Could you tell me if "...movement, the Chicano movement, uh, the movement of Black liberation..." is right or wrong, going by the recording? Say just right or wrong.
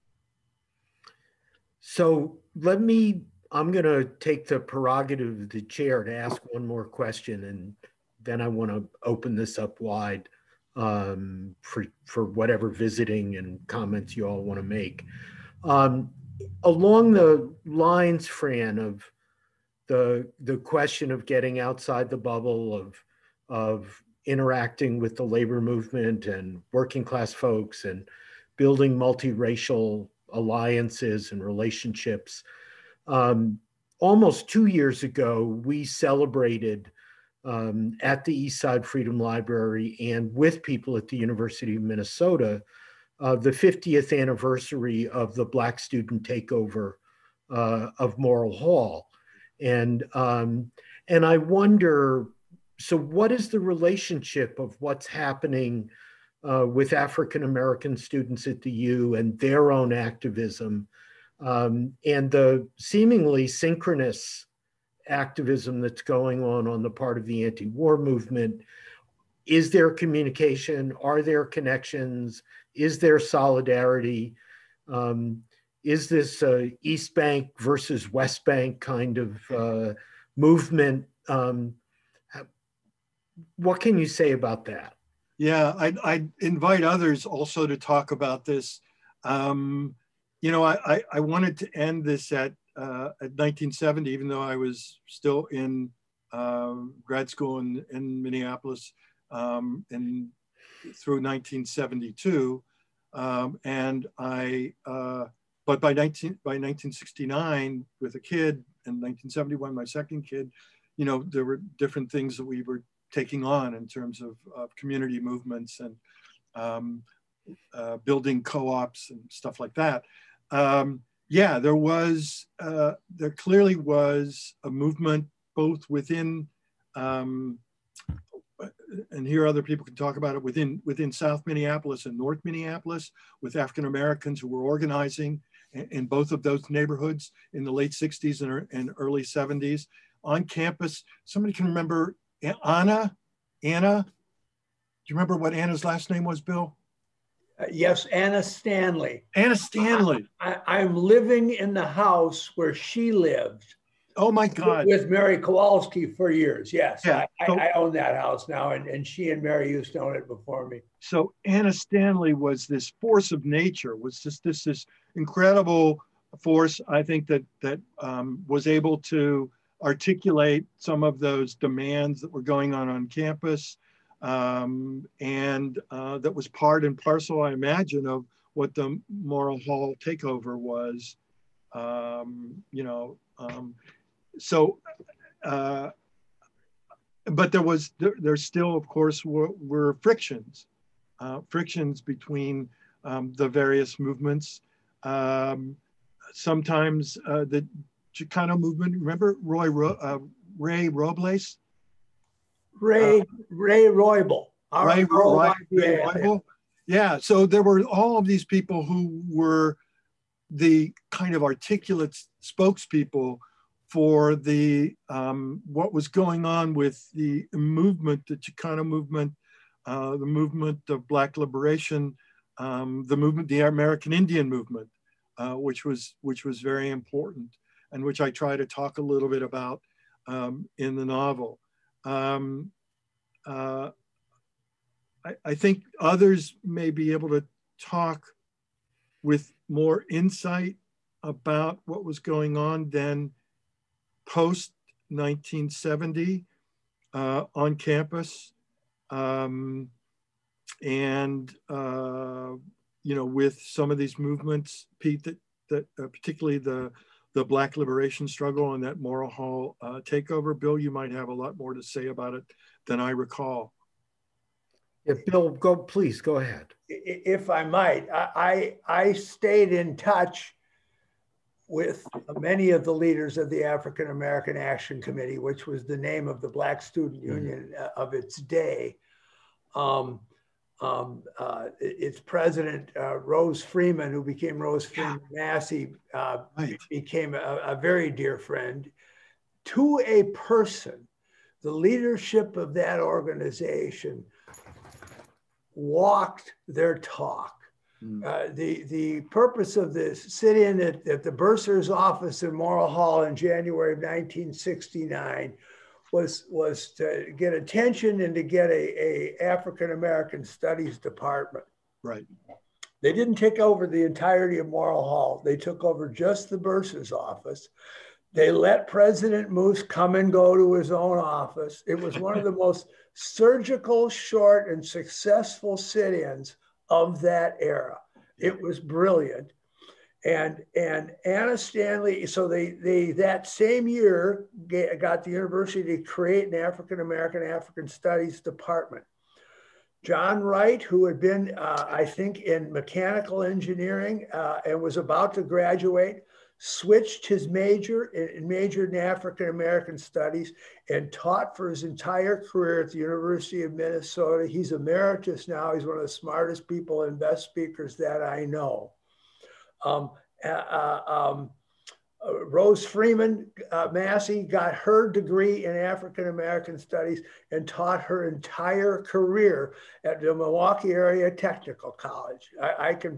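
right.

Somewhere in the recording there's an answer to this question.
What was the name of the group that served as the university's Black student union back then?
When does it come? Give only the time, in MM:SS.
04:33.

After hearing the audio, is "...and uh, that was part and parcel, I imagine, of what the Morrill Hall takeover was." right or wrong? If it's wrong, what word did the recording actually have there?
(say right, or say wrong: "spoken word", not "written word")
right.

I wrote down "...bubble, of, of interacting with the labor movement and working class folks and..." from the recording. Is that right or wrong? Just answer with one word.
right.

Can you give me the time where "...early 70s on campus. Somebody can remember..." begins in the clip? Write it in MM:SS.
02:18.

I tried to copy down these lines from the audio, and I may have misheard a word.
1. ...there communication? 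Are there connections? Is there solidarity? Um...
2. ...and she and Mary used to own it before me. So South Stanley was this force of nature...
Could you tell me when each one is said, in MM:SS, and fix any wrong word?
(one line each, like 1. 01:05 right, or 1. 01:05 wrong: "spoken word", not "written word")
1. 01:09 right
2. 02:38 wrong: "Anna", not "South".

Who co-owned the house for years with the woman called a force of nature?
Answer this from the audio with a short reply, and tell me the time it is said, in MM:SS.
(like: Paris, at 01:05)
Mary Kowalski, at 02:35.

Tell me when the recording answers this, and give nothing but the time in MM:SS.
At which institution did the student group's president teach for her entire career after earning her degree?
06:10.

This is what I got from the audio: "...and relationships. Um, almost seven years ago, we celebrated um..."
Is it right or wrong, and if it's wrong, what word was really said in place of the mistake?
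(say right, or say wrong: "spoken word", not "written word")
wrong: "two", not "seven".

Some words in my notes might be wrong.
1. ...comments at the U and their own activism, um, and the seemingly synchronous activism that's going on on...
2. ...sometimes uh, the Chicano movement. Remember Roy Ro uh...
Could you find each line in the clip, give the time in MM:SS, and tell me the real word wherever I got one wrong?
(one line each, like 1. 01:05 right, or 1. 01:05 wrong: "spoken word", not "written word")
1. 00:57 wrong: "students", not "comments"
2. 03:16 right.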